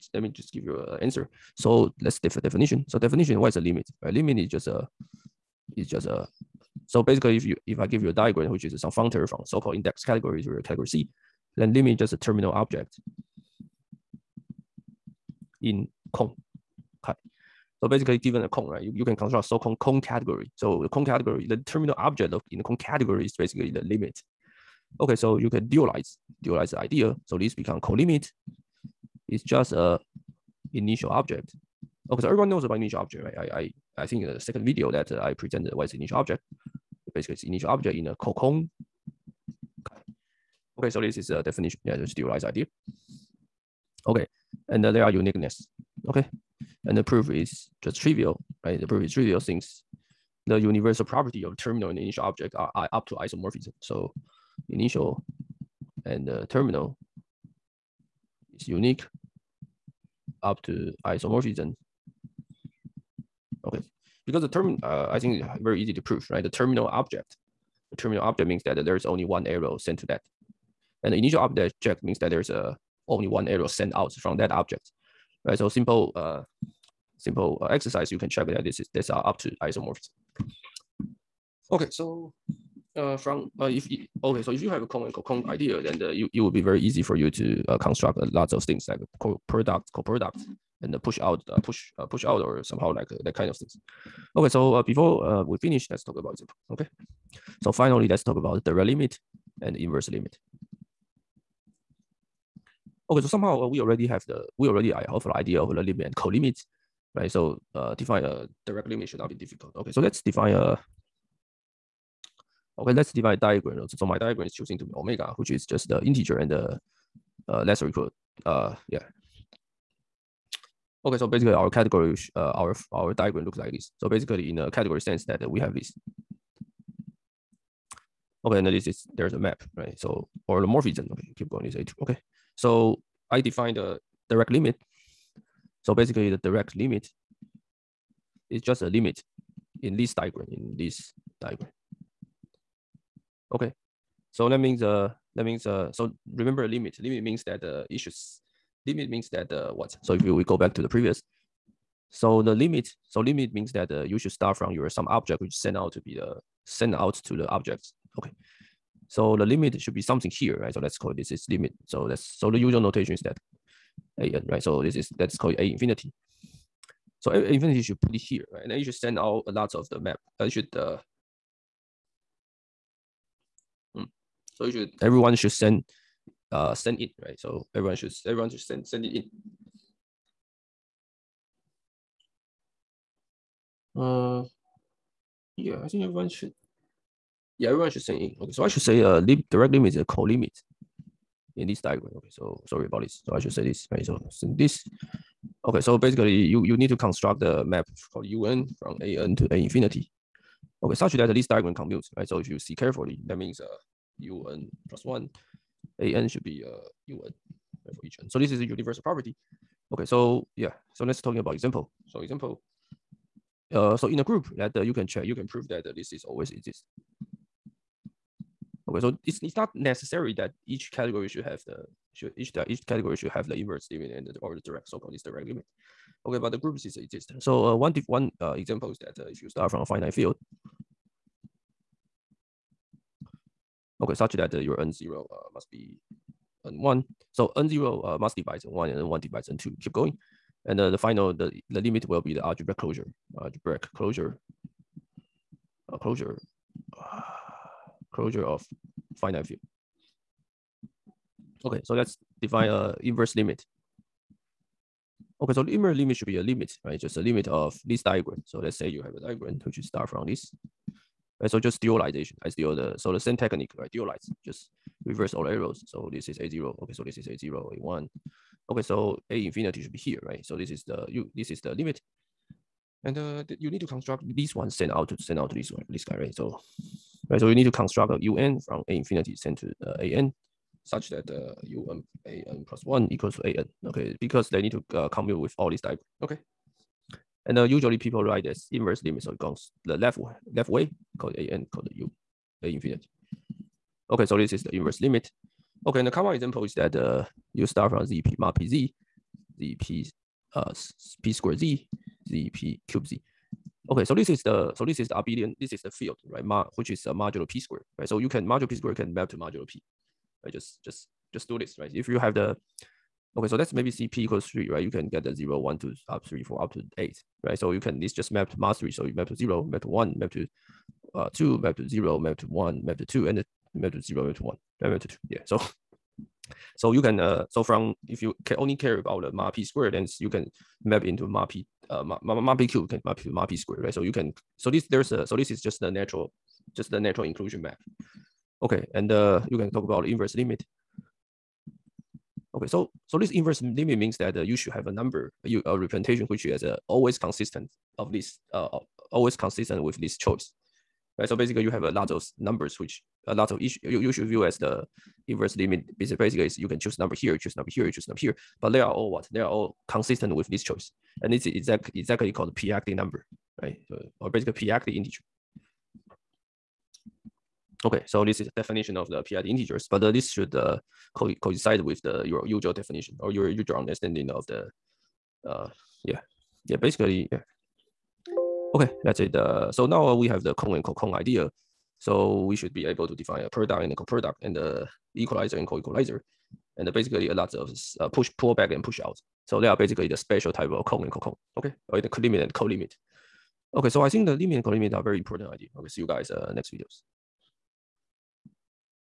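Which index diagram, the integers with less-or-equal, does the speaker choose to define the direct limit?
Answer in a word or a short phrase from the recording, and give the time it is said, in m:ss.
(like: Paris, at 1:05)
Omega, at 1:54.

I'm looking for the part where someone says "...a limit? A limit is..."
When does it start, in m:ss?
0:03.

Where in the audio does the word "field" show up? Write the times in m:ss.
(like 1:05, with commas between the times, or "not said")
3:50, 4:09, 5:05.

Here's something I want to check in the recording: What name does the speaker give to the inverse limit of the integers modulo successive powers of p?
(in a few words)
p-adic number.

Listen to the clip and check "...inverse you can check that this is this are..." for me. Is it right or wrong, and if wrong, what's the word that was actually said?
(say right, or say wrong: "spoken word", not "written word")
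wrong: "exercise", not "inverse".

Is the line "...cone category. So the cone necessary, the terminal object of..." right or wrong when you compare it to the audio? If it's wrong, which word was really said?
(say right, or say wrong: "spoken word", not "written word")
wrong: "category", not "necessary".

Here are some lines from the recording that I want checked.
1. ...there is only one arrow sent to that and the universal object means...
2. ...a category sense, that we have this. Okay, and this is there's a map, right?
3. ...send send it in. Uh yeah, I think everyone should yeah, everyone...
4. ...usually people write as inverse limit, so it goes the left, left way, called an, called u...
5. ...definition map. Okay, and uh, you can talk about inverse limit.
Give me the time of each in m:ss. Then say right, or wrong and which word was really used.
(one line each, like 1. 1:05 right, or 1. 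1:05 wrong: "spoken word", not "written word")
1. 1:08 wrong: "initial", not "universal"
2. 2:04 right
3. 2:58 right
4. 4:47 right
5. 5:37 wrong: "inclusion", not "definition".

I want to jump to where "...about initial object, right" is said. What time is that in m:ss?
0:32.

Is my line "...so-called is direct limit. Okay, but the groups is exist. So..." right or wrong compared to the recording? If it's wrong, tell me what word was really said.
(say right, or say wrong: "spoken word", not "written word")
right.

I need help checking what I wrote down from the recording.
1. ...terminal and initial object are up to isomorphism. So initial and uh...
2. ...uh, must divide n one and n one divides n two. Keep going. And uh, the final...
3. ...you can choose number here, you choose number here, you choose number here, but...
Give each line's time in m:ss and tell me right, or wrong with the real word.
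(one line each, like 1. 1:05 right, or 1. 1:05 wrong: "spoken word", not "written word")
1. 0:51 right
2. 3:58 right
3. 5:56 right.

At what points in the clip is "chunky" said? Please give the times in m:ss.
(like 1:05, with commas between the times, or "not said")
not said.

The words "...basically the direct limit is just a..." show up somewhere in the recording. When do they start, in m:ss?
2:15.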